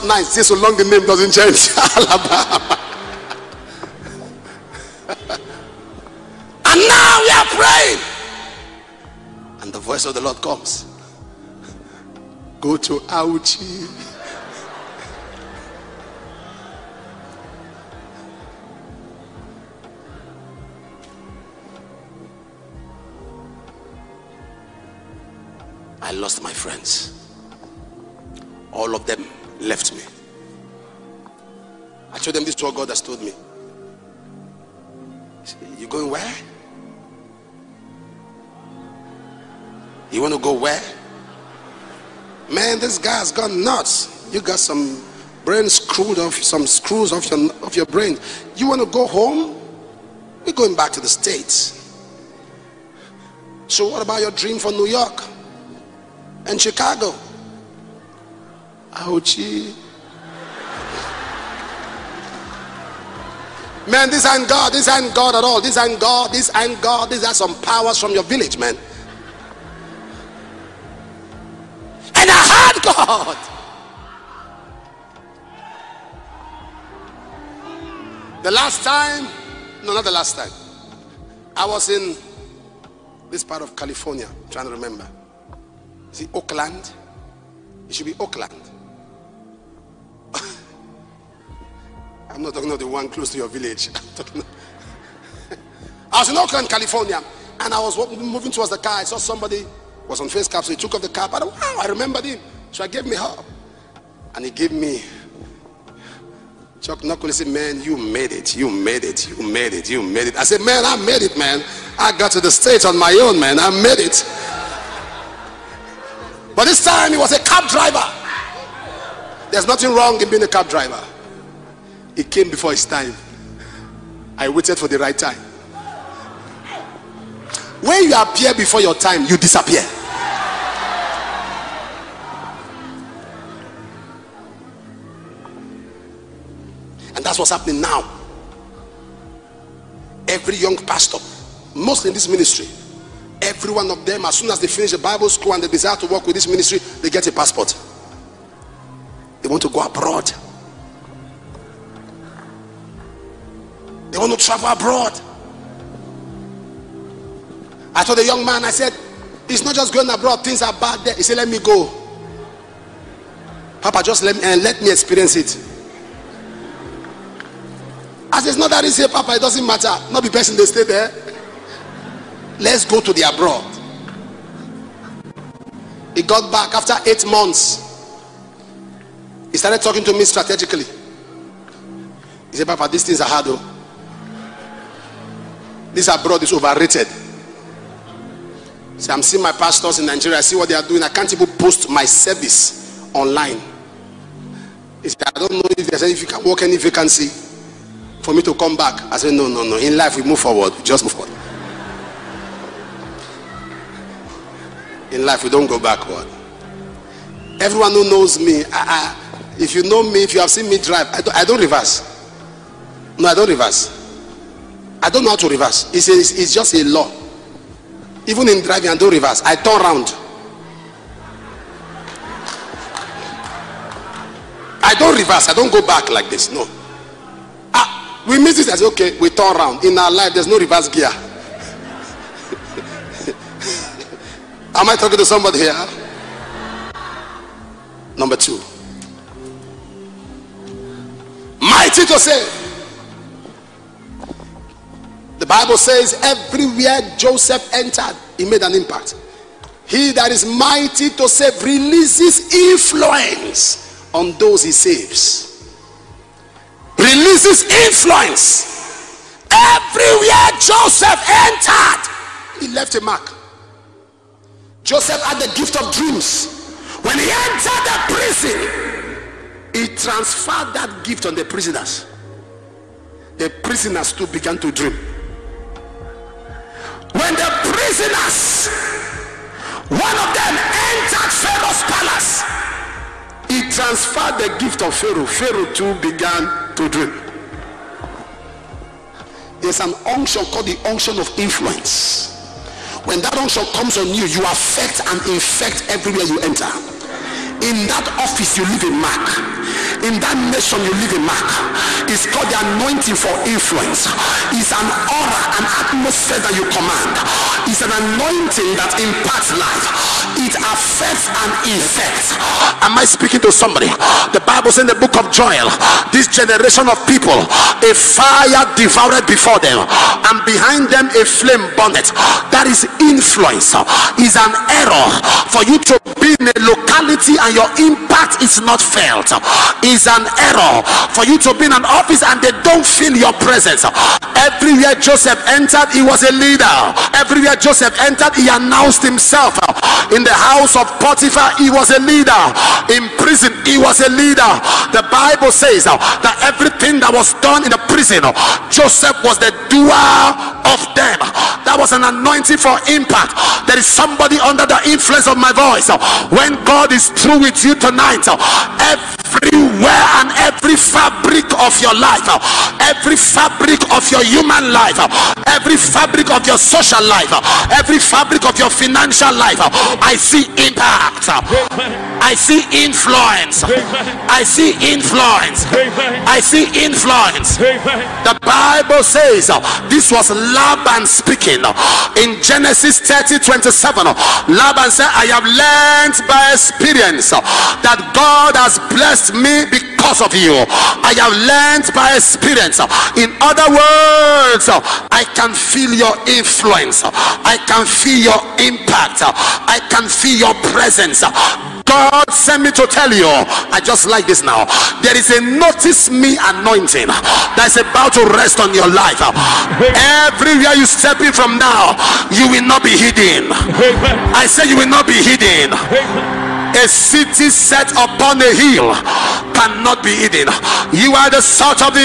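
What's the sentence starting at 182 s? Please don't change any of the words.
He said, Papa, these things are hard.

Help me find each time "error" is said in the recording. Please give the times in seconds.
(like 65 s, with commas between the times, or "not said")
324 s, 330 s.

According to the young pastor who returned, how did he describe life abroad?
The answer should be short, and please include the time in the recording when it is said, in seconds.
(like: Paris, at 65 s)
Overrated, at 186 s.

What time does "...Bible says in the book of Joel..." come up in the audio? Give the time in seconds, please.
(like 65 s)
314 s.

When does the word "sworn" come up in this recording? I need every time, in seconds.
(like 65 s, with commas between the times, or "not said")
not said.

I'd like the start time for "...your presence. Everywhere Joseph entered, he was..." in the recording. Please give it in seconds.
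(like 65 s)
333 s.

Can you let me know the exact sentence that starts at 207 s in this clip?
Everyone who knows me, I, I, if you know me, if you have seen me drive, I don't, I don't reverse.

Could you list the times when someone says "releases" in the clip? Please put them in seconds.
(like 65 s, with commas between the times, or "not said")
251 s, 256 s.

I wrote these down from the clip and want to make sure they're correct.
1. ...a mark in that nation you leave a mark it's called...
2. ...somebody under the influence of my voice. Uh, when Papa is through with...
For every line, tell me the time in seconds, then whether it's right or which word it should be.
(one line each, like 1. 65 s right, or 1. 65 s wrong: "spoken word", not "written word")
1. 298 s right
2. 353 s wrong: "God", not "Papa".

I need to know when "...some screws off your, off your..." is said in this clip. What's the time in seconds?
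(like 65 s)
46 s.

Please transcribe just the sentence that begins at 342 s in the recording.
In prison, he was a leader.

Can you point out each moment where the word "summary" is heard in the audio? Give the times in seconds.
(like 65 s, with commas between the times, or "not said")
not said.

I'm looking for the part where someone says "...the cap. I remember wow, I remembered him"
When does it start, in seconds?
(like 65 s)
101 s.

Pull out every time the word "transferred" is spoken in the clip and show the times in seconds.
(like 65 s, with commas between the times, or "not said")
269 s, 283 s.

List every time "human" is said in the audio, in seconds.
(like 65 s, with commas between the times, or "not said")
364 s.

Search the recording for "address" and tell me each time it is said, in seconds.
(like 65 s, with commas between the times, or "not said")
not said.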